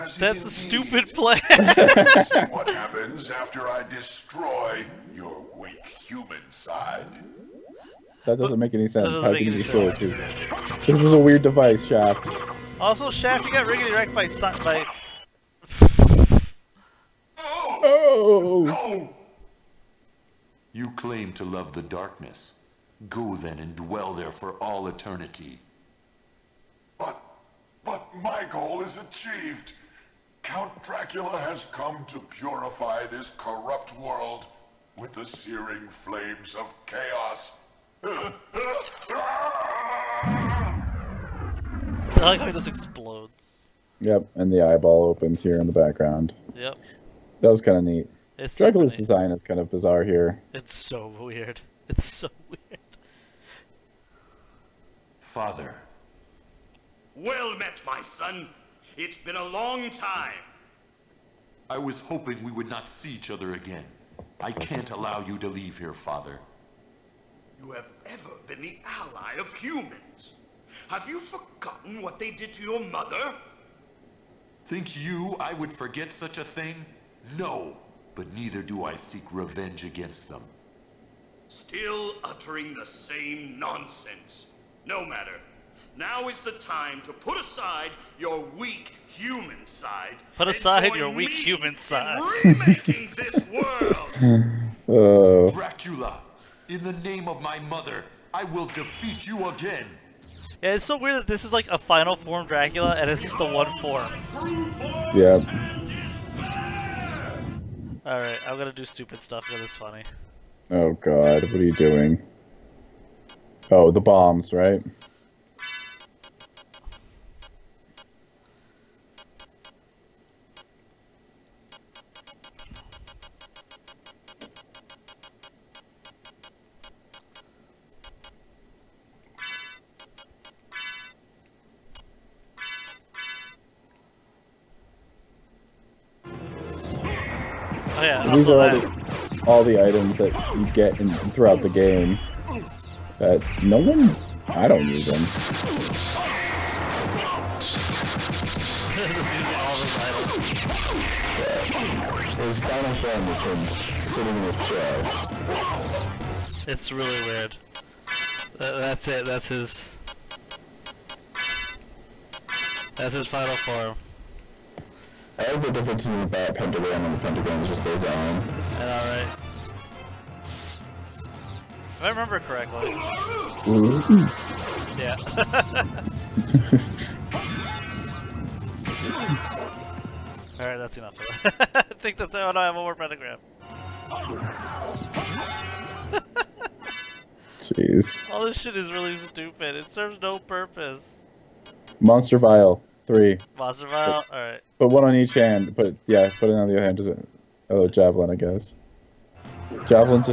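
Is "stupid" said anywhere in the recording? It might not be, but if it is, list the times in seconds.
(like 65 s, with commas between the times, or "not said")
0 s, 108 s, 189 s.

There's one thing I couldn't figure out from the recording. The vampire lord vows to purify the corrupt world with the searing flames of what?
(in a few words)
Chaos.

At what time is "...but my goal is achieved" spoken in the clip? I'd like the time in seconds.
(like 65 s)
27 s.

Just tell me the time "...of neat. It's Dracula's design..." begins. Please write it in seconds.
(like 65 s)
47 s.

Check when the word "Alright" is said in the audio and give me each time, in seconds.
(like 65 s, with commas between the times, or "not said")
108 s, 180 s, 194 s.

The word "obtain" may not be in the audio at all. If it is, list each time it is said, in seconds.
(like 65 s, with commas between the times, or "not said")
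not said.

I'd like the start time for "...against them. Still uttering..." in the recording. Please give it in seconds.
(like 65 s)
79 s.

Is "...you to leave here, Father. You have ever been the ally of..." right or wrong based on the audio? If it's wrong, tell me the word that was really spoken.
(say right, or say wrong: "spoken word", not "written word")
right.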